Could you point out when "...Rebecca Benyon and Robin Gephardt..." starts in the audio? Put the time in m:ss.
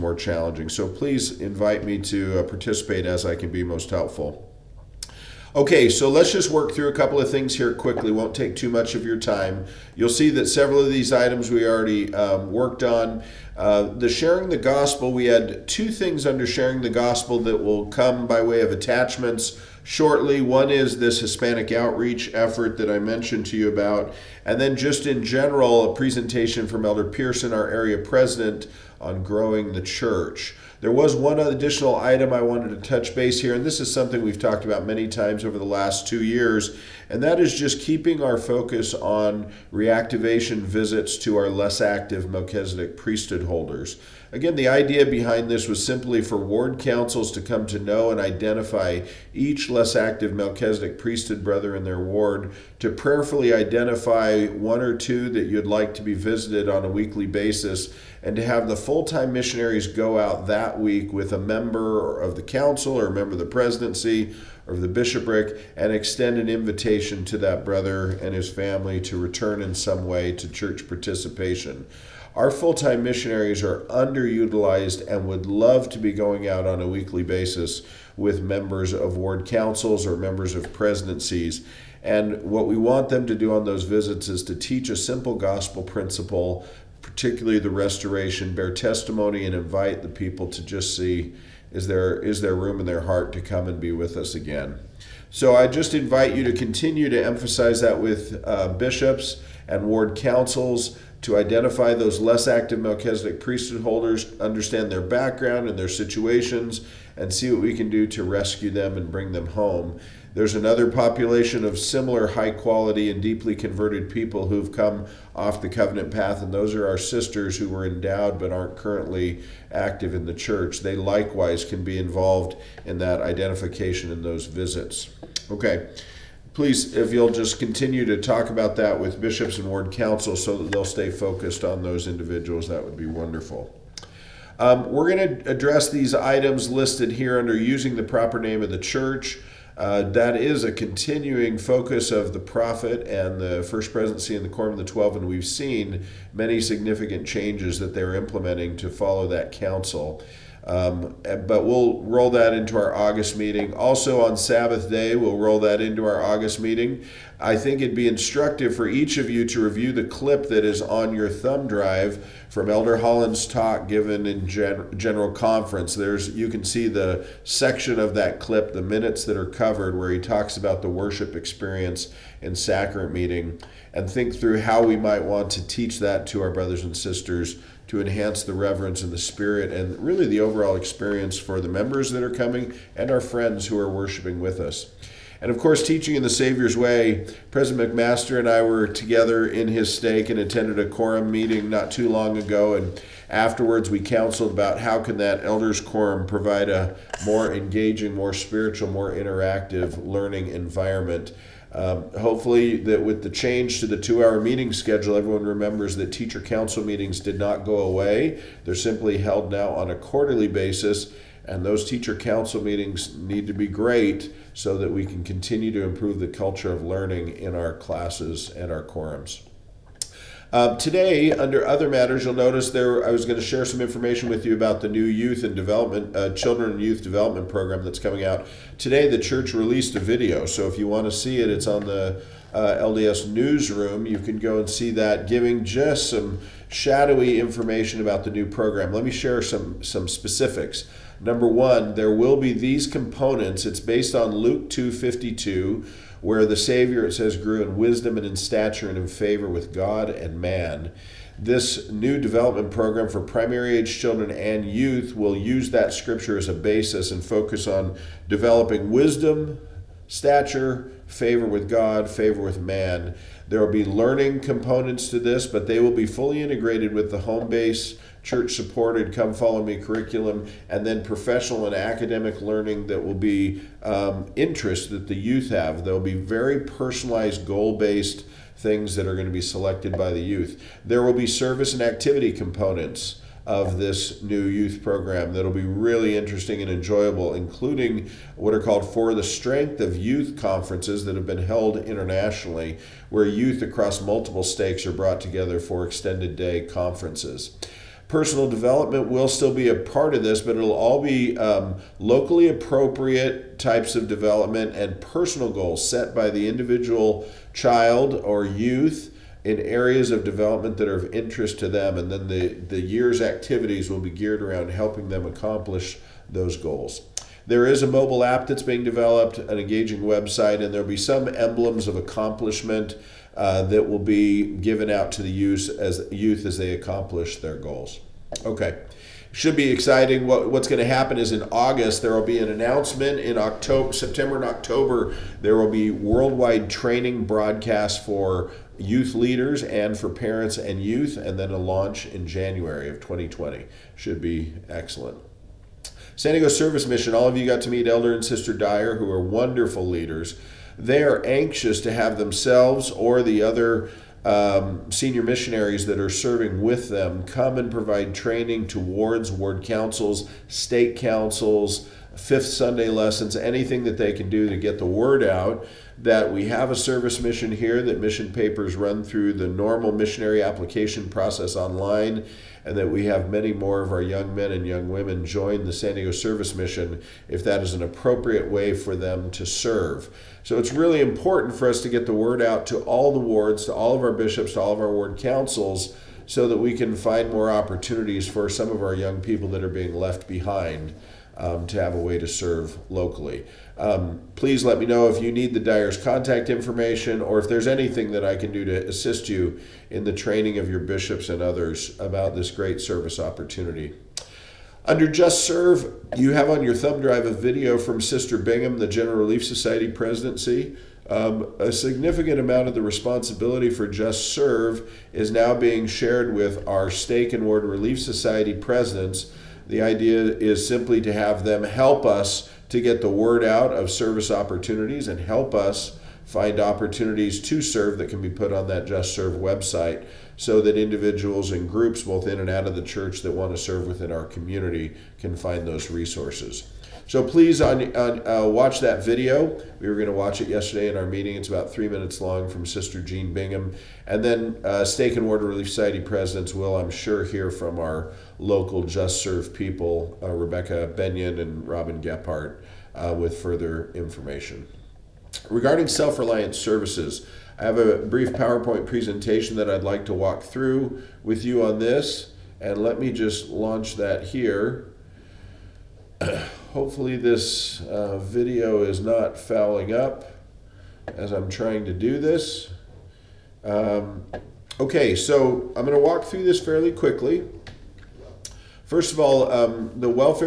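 7:30.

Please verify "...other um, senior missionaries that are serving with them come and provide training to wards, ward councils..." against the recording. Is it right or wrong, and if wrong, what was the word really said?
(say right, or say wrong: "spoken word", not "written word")
right.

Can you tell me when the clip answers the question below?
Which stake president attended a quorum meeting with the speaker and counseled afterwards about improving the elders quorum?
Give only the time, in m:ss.
3:07.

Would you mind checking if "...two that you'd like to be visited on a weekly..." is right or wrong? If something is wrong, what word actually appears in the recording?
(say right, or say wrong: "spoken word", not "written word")
right.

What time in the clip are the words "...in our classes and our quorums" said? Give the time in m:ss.
3:37.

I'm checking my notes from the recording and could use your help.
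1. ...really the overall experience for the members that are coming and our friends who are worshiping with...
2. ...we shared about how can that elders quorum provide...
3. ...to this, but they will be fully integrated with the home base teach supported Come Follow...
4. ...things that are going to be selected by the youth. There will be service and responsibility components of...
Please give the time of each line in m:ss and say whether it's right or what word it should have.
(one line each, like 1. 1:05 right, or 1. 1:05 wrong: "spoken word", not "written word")
1. 3:00 right
2. 3:13 wrong: "counseled", not "shared"
3. 4:25 wrong: "church", not "teach"
4. 4:38 wrong: "activity", not "responsibility".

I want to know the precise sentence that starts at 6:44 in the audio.
Under Just Serve, you have on your thumb drive a video from Sister Bingham, the General Relief Society presidency.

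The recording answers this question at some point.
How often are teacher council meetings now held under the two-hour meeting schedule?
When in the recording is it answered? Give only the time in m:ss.
3:29.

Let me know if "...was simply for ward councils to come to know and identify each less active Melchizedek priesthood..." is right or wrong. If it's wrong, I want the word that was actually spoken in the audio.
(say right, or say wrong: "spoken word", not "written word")
right.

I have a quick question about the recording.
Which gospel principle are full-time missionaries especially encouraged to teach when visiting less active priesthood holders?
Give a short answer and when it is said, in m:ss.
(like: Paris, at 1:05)
the restoration, at 1:27.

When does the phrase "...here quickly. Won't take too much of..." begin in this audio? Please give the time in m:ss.
0:07.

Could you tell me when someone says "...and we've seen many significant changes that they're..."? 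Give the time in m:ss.
2:25.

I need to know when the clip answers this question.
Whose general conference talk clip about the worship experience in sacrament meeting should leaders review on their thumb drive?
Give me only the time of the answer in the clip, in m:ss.
2:42.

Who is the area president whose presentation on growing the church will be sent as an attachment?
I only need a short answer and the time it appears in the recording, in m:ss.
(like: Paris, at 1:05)
Elder Pearson, at 0:26.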